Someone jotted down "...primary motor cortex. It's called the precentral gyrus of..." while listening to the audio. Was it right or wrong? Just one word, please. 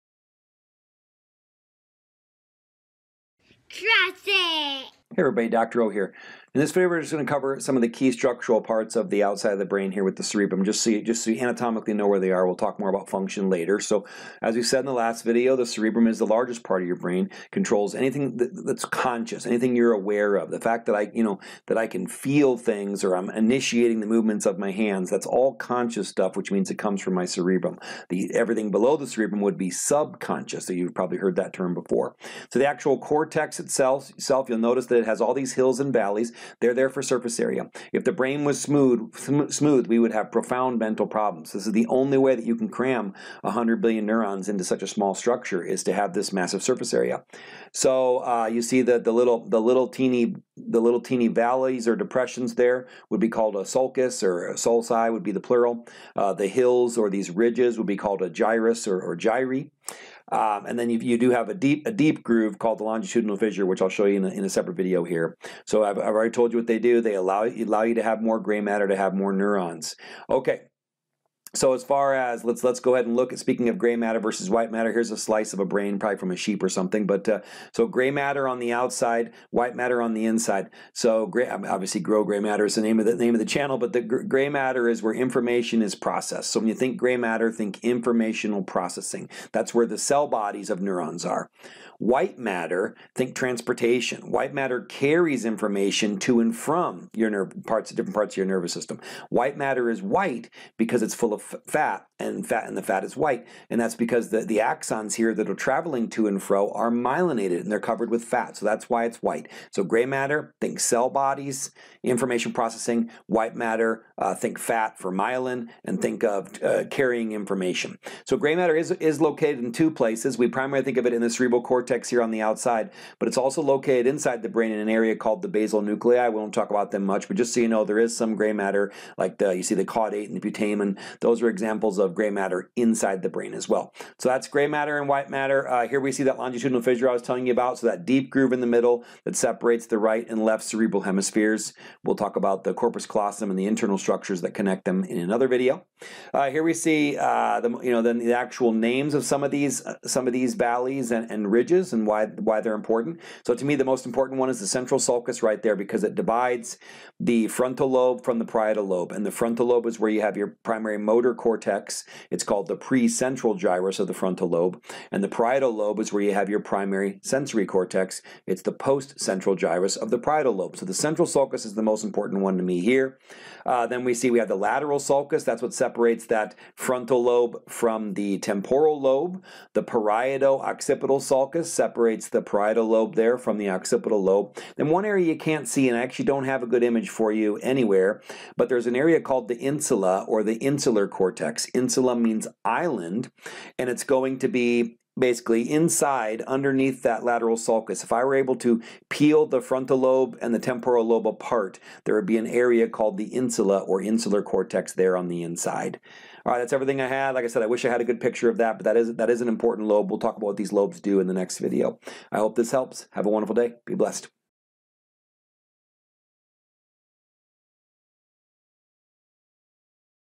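right.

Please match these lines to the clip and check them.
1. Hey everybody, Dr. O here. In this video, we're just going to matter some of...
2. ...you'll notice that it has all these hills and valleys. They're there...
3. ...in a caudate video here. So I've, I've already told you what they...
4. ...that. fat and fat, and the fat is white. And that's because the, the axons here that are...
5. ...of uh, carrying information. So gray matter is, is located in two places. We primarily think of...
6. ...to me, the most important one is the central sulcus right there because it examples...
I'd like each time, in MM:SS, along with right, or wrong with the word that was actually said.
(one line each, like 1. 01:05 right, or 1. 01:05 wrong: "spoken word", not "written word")
1. 00:05 wrong: "cover", not "matter"
2. 00:34 right
3. 01:04 wrong: "separate", not "caudate"
4. 01:41 right
5. 01:56 right
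6. 02:33 wrong: "divides", not "examples".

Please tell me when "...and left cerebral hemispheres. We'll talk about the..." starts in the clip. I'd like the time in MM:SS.
02:20.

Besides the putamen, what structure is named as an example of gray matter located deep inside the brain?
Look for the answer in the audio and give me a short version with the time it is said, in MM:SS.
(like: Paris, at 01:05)
caudate, at 02:09.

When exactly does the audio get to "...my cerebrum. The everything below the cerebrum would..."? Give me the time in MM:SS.
00:27.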